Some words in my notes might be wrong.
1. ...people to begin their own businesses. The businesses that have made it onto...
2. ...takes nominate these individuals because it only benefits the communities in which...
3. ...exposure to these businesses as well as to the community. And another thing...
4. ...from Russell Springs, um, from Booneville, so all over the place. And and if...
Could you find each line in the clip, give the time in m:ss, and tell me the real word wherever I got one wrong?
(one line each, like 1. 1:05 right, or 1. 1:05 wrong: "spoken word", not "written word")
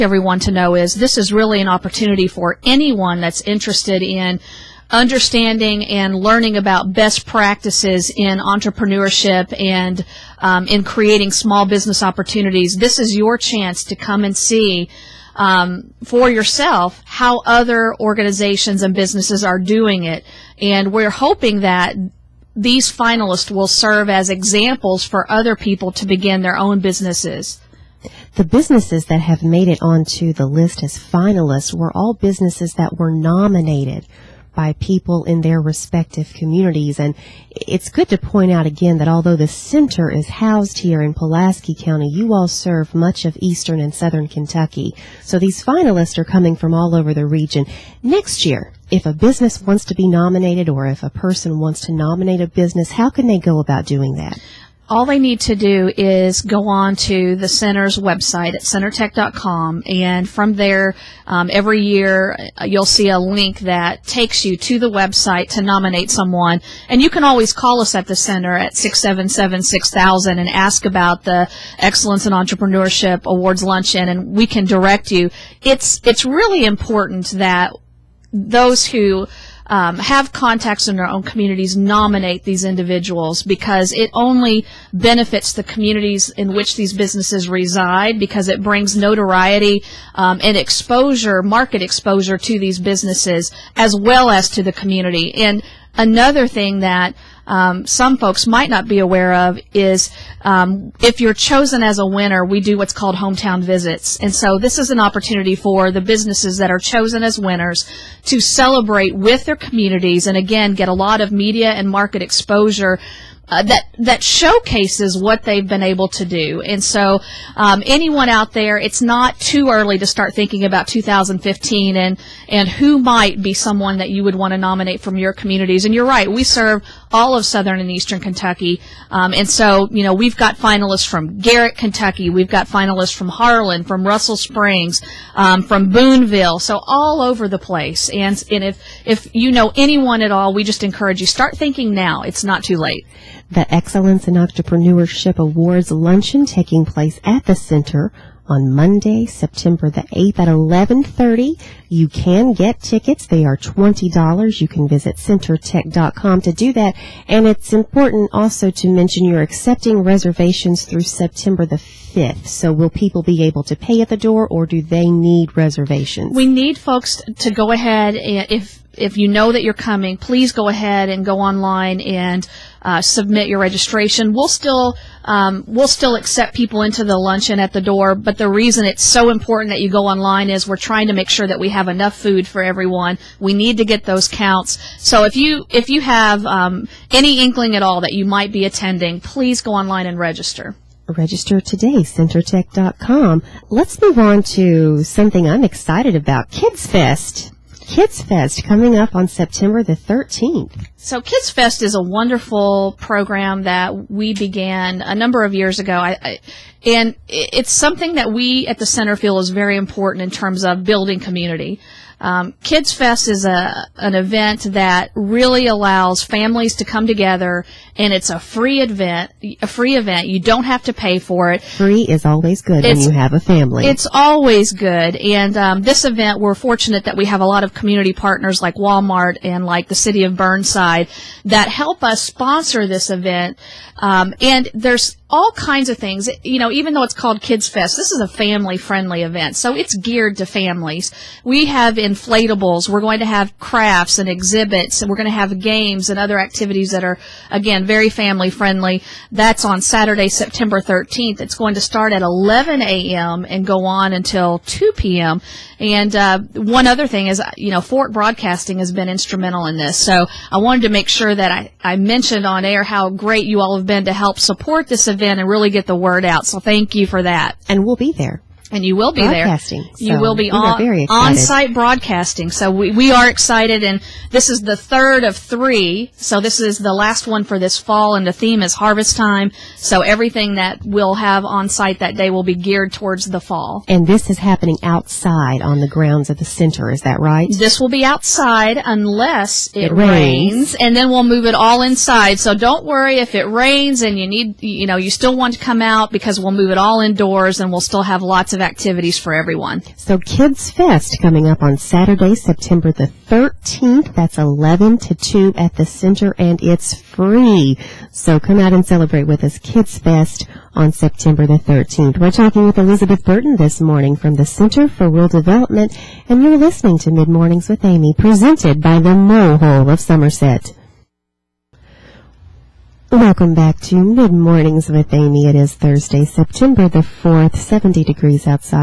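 1. 0:25 right
2. 1:21 wrong: "communities", not "takes"
3. 1:31 right
4. 2:13 right.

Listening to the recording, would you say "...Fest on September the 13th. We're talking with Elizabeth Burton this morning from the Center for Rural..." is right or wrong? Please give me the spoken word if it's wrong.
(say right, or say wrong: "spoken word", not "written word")
right.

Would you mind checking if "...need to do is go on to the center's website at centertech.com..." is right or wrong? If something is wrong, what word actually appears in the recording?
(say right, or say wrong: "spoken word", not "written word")
right.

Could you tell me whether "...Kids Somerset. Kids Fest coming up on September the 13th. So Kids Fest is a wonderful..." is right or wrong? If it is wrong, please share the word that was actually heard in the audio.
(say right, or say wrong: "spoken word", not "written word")
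wrong: "Fest", not "Somerset".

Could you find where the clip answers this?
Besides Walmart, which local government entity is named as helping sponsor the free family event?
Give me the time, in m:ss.
3:49.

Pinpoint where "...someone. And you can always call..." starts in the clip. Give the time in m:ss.
1:06.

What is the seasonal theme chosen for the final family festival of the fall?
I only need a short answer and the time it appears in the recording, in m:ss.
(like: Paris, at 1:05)
Harvest time, at 4:38.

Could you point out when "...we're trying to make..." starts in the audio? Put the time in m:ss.
3:00.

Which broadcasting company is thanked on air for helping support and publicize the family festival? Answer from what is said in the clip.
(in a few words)
Forcht Broadcasting.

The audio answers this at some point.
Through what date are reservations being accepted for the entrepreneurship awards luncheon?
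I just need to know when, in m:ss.
2:41.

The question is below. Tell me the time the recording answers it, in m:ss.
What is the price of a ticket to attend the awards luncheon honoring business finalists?
2:33.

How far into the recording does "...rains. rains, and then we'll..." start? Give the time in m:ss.
4:49.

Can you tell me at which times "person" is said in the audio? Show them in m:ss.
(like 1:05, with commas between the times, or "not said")
0:51.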